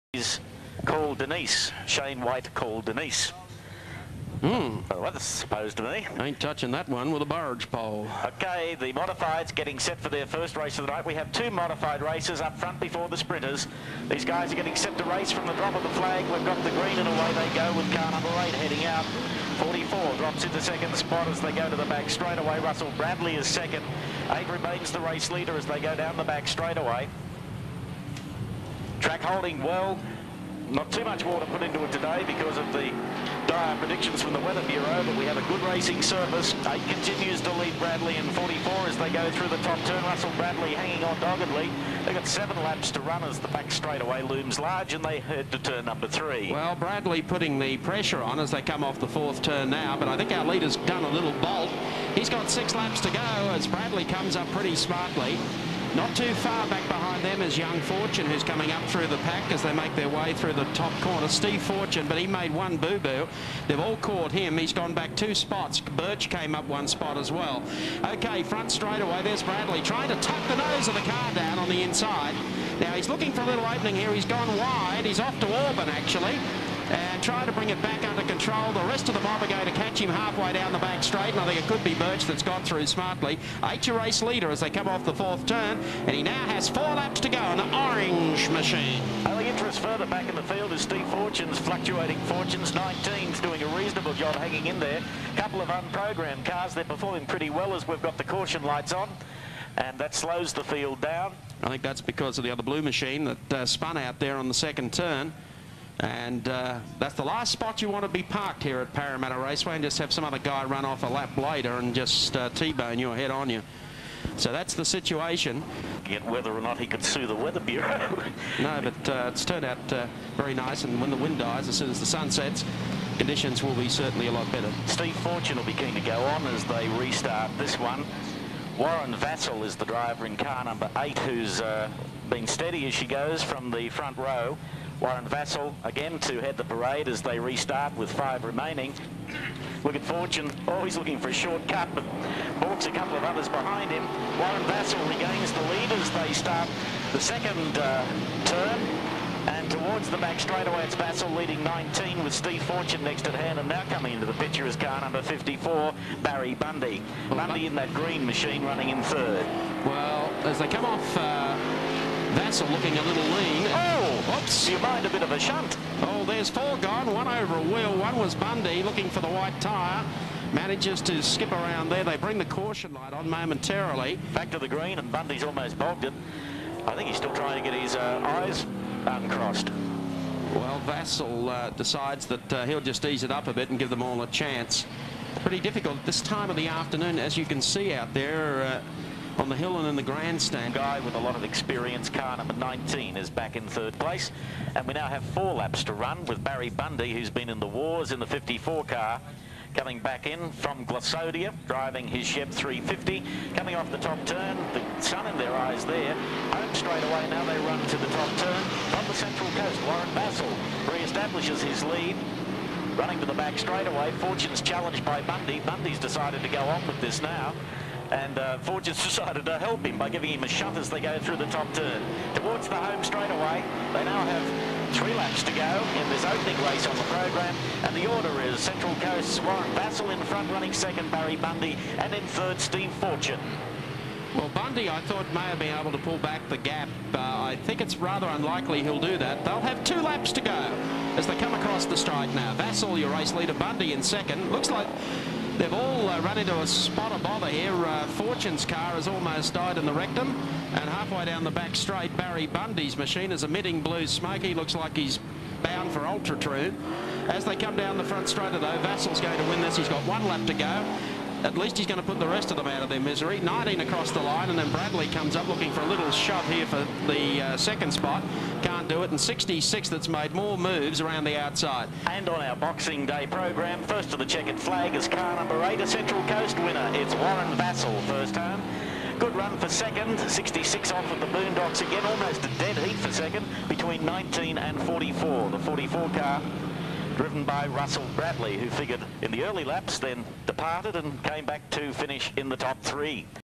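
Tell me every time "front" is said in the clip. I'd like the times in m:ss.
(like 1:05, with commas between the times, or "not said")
0:12, 1:08, 2:13, 3:50, 4:18.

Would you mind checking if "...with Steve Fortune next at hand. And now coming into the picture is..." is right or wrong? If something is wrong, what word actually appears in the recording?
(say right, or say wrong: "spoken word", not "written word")
right.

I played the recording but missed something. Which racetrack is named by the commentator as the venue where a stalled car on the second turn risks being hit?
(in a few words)
Parramatta Raceway.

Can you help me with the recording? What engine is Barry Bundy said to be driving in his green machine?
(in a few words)
Chev 350.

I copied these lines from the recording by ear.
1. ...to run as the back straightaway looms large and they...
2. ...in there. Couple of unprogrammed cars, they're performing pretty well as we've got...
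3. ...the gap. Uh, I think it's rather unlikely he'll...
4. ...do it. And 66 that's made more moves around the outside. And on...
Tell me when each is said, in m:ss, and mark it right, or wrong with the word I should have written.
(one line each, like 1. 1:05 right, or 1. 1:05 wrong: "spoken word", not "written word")
1. 0:42 right
2. 1:34 right
3. 3:56 right
4. 4:28 right.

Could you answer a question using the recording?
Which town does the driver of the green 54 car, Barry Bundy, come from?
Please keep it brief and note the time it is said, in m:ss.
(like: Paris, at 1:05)
Glossodia, at 3:20.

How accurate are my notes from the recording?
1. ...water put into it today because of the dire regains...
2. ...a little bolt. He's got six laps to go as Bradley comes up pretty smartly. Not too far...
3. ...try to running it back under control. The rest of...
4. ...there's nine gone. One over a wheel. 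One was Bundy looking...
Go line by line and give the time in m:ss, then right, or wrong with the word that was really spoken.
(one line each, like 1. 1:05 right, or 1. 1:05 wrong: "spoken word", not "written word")
1. 0:31 wrong: "predictions", not "regains"
2. 0:51 right
3. 1:17 wrong: "bring", not "running"
4. 2:46 wrong: "four", not "nine".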